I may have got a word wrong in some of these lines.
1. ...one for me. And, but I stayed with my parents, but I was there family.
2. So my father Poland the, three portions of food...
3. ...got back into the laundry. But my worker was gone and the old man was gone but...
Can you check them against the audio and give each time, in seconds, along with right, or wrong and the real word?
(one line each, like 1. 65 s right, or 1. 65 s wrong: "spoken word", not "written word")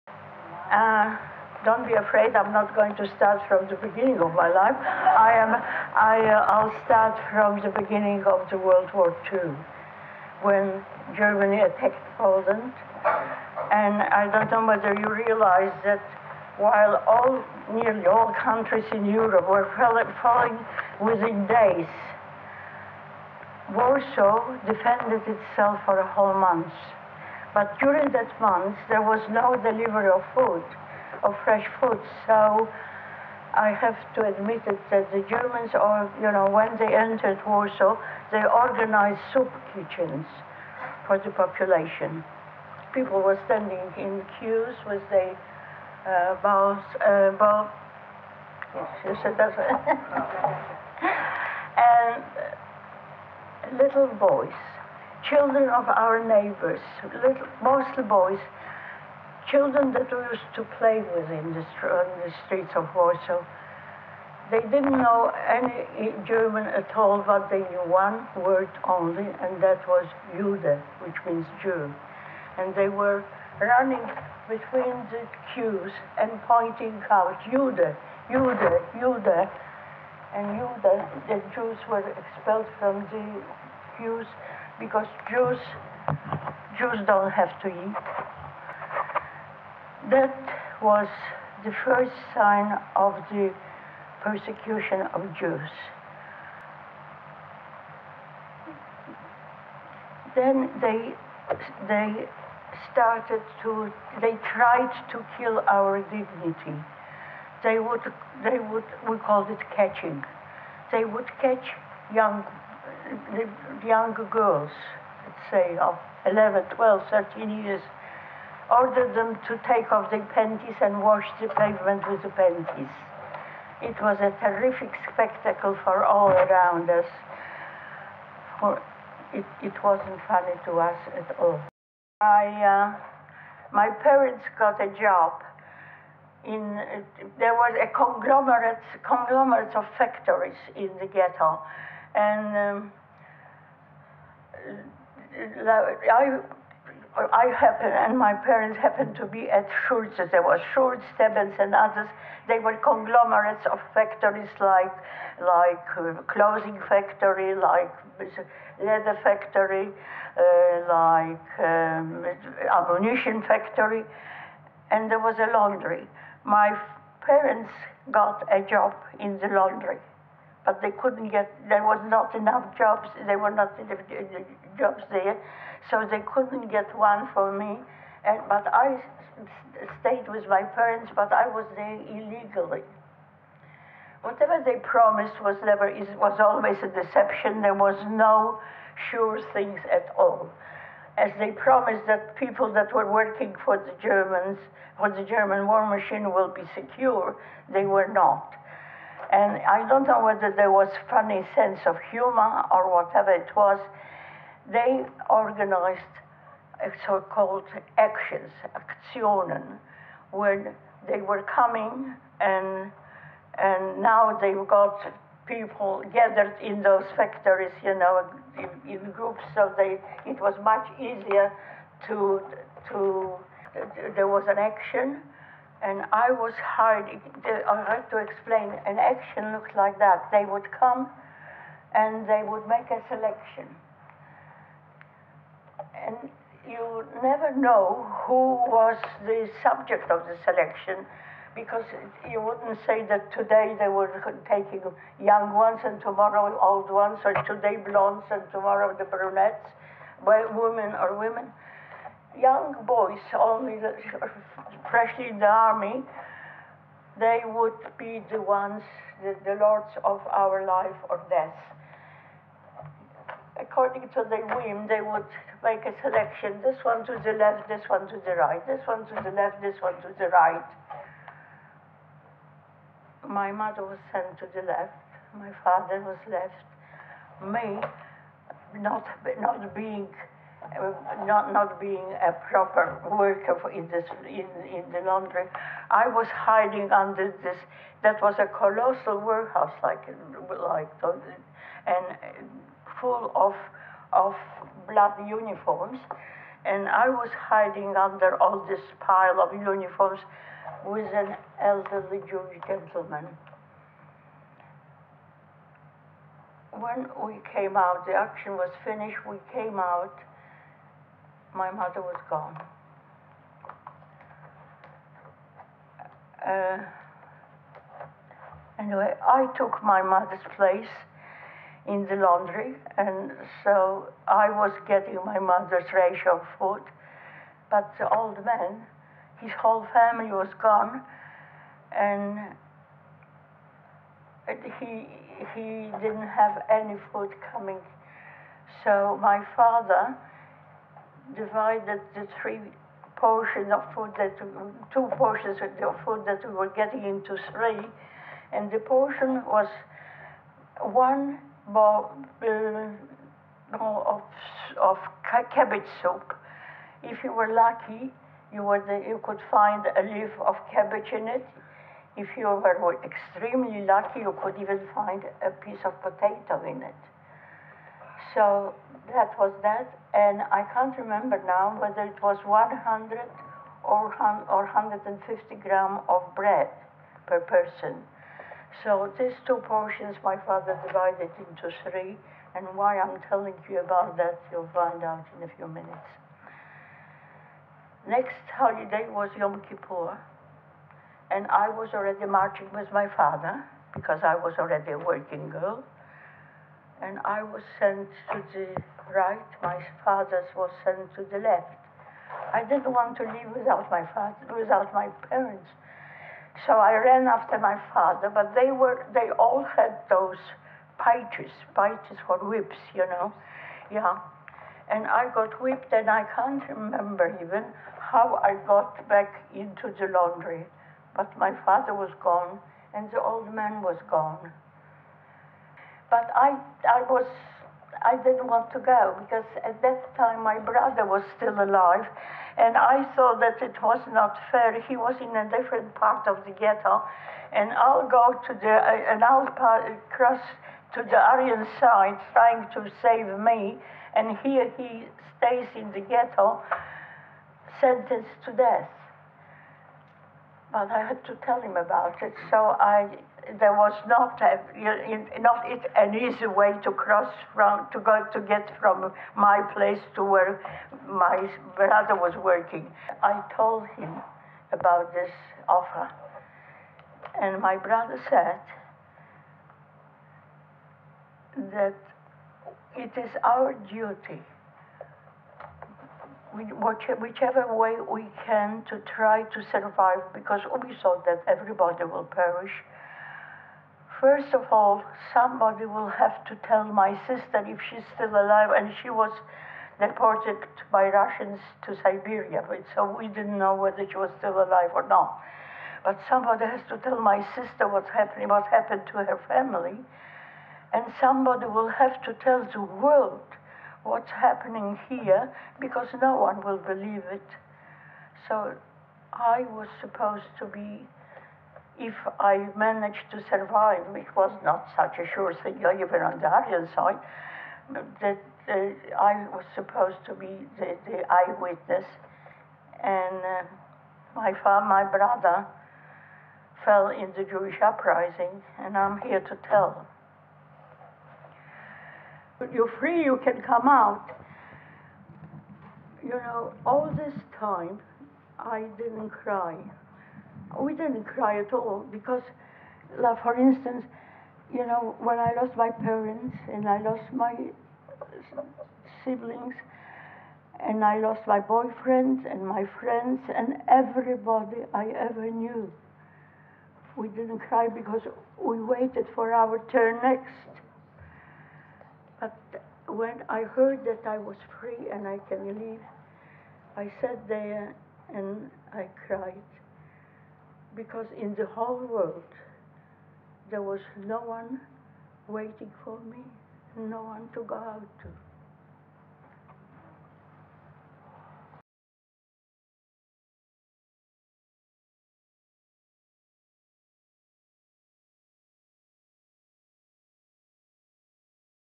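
1. 176 s wrong: "illegally", not "family"
2. 338 s wrong: "Divided", not "Poland"
3. 418 s wrong: "father", not "worker".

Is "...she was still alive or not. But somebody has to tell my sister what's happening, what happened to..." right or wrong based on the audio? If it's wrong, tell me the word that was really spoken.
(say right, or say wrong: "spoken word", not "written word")
right.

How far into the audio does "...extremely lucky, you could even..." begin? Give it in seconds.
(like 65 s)
363 s.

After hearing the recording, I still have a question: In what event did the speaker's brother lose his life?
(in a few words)
the Jewish uprising.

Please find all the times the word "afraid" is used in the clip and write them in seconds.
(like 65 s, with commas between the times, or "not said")
1 s.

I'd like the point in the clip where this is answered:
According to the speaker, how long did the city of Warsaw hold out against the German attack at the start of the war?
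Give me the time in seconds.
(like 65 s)
25 s.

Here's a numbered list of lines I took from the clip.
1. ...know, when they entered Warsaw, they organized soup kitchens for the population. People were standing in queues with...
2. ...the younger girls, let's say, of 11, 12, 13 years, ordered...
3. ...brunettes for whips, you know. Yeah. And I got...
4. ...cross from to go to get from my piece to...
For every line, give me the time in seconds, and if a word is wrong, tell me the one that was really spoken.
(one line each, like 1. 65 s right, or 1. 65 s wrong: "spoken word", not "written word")
1. 36 s right
2. 113 s right
3. 411 s wrong: "pitches", not "brunettes"
4. 456 s wrong: "place", not "piece".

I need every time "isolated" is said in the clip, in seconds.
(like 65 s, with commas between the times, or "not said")
not said.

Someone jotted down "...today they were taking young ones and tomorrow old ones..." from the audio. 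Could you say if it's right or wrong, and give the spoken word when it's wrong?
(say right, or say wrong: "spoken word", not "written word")
right.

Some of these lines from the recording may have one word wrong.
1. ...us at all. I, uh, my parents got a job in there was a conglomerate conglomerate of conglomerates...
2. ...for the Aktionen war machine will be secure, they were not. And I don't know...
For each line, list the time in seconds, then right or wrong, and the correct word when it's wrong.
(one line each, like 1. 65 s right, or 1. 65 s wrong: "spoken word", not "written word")
1. 130 s wrong: "factories", not "conglomerates"
2. 194 s wrong: "German", not "Aktionen".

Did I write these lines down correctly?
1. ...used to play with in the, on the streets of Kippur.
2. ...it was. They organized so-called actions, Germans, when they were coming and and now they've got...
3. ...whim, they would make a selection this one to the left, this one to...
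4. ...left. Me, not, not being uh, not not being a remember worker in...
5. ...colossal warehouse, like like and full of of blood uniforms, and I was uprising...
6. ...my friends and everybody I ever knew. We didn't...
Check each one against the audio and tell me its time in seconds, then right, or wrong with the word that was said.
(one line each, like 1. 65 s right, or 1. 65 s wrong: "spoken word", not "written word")
1. 60 s wrong: "Warsaw", not "Kippur"
2. 203 s wrong: "Aktionen", not "Germans"
3. 264 s right
4. 276 s wrong: "proper", not "remember"
5. 288 s wrong: "hiding", not "uprising"
6. 552 s right.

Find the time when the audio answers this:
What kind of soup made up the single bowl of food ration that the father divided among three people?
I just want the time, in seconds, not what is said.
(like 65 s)
355 s.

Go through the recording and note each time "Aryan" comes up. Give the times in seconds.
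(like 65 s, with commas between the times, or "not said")
441 s, 516 s.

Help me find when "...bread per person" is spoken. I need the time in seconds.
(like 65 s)
376 s.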